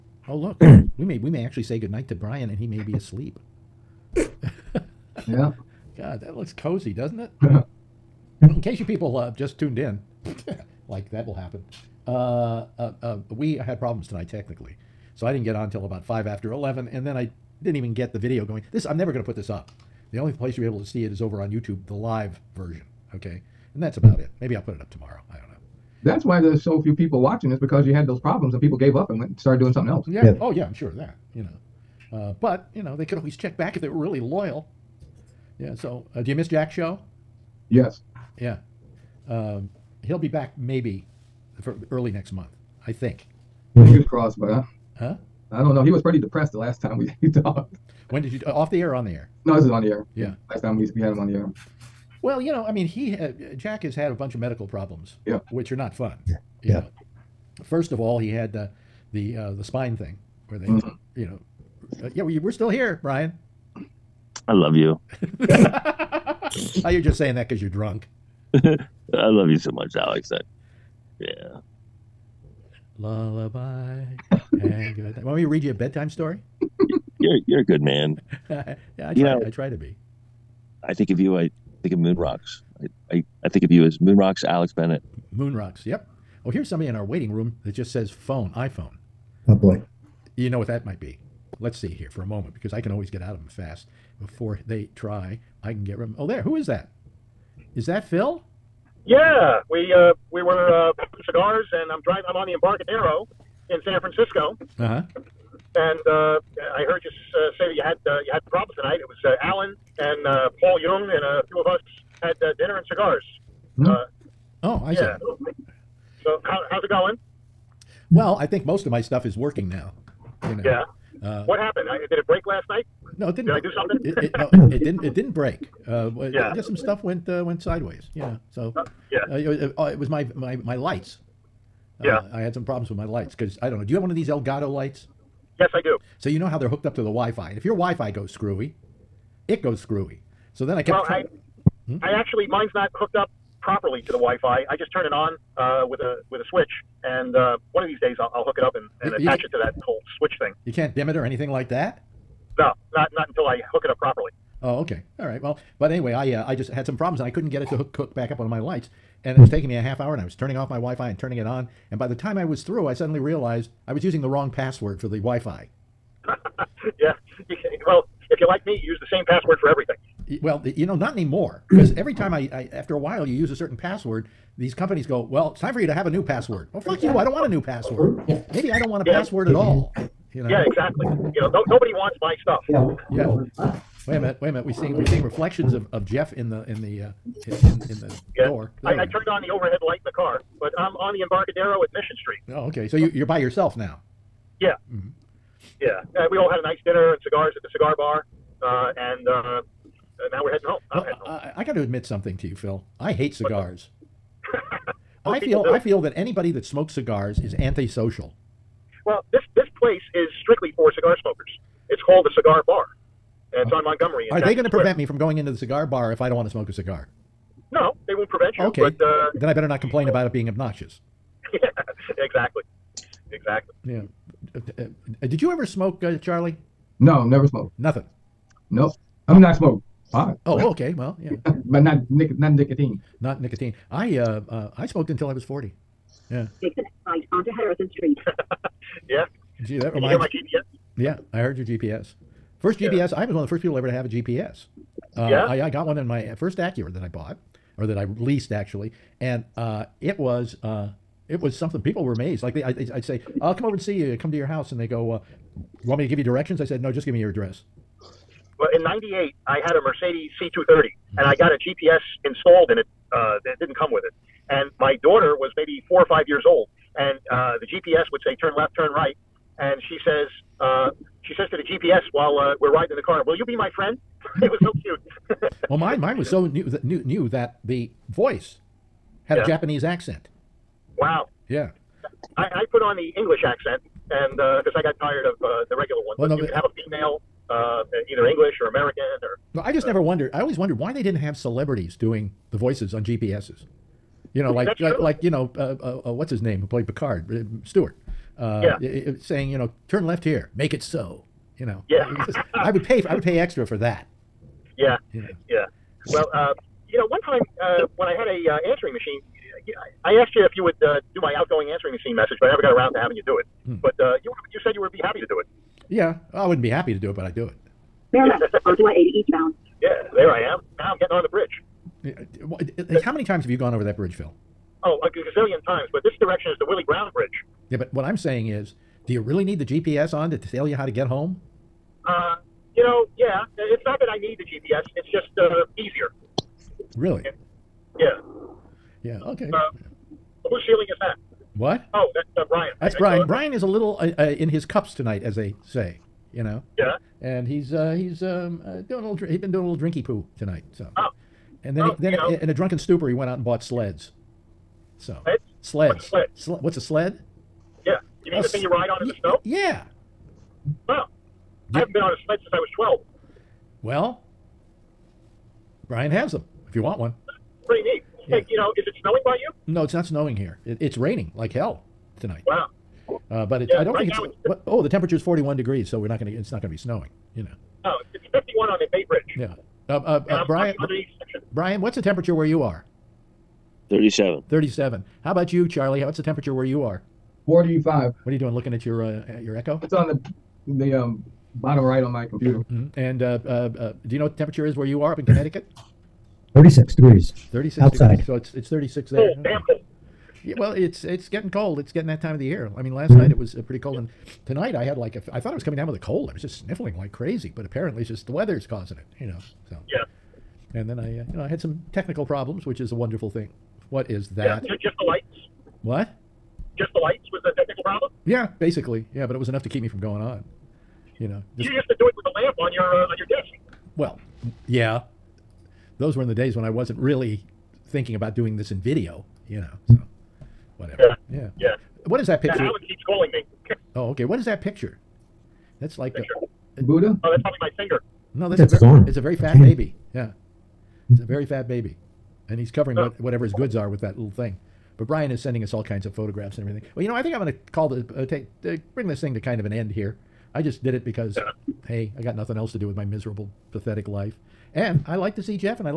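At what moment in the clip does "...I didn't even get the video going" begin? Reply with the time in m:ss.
0:17.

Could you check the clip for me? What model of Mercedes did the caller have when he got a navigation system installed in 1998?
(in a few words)
C230.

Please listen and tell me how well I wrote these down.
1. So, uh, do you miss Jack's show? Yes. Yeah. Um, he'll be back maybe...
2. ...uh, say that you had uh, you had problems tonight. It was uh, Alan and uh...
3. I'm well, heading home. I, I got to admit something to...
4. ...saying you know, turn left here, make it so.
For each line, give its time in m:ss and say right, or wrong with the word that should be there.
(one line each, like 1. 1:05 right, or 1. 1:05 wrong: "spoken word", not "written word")
1. 0:35 right
2. 1:47 right
3. 3:20 right
4. 4:59 right.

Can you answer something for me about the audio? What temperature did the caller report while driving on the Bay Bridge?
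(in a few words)
51.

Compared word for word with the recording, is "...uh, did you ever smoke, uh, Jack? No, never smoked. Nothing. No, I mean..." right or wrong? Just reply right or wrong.
wrong.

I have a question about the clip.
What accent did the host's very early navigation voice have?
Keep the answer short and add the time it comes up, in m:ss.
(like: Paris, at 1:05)
Japanese, at 4:39.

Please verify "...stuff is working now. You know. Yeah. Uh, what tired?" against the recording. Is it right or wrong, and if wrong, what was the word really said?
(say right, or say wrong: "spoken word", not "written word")
wrong: "happened", not "tired".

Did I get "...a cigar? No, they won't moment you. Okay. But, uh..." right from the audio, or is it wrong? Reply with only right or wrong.
wrong.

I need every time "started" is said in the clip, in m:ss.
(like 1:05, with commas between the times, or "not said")
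0:29.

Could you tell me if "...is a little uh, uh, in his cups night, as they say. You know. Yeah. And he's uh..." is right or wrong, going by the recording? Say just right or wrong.
wrong.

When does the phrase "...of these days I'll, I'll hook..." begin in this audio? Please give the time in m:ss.
2:27.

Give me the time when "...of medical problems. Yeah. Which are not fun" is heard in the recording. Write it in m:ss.
0:54.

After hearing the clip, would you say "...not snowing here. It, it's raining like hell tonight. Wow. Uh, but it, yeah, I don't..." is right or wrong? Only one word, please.
right.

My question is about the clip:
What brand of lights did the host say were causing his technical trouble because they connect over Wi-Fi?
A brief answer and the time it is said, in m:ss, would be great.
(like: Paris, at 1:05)
Elgato, at 2:14.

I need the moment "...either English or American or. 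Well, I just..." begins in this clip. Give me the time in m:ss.
4:48.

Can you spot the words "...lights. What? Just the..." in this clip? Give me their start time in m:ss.
6:55.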